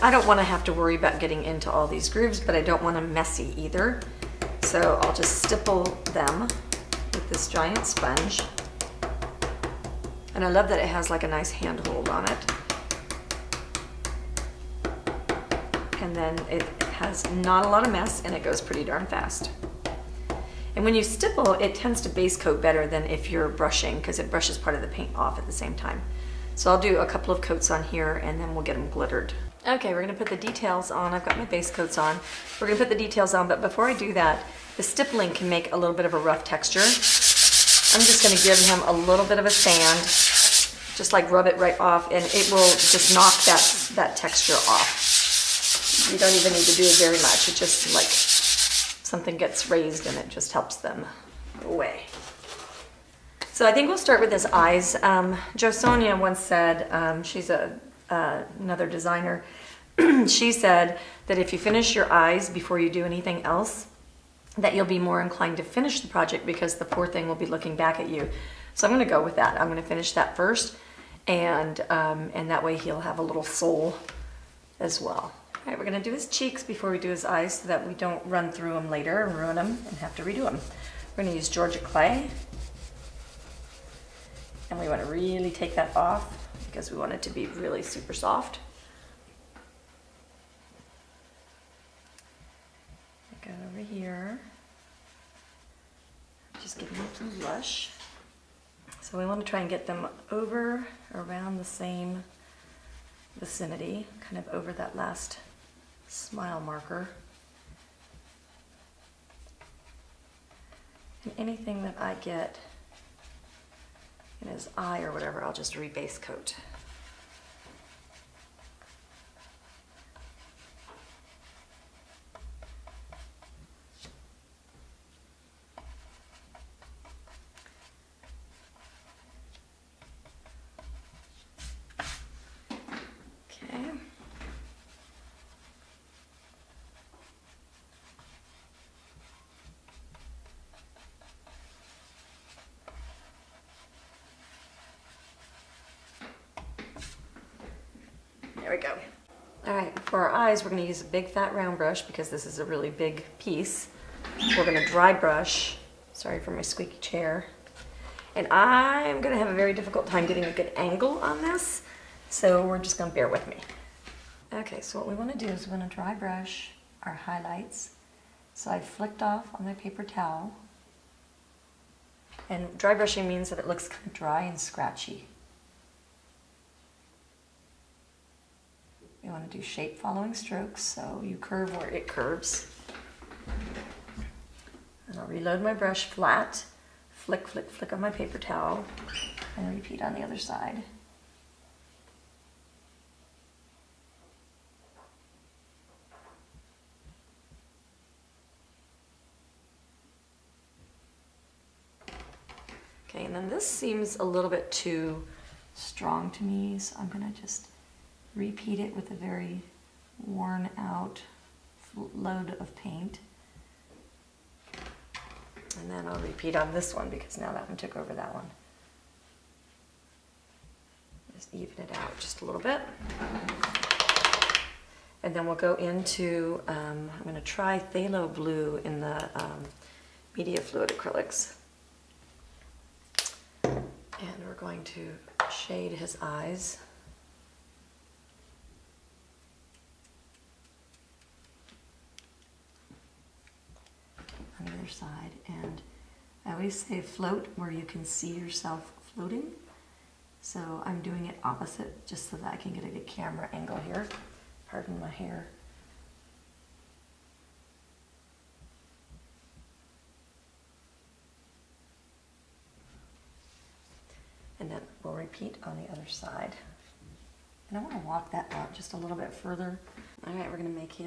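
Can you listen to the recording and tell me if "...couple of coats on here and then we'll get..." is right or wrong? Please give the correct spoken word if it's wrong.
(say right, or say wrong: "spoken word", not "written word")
right.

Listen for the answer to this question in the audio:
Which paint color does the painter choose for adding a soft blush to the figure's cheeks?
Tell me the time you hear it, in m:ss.
1:21.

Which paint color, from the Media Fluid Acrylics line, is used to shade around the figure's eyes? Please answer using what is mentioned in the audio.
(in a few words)
Phthalo Blue.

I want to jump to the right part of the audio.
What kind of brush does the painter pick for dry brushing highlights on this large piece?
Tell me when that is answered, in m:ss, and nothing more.
2:31.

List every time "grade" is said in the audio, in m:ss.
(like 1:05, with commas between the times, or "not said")
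not said.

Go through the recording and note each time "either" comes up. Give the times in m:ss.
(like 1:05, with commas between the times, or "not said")
0:03, 4:04.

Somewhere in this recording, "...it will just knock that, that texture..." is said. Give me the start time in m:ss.
0:42.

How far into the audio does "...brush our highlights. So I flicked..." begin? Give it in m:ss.
2:46.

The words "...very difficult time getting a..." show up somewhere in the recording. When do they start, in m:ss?
2:39.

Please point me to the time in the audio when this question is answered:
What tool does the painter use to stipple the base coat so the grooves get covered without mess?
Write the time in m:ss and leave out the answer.
0:07.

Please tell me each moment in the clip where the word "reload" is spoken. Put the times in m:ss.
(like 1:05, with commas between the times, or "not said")
3:05.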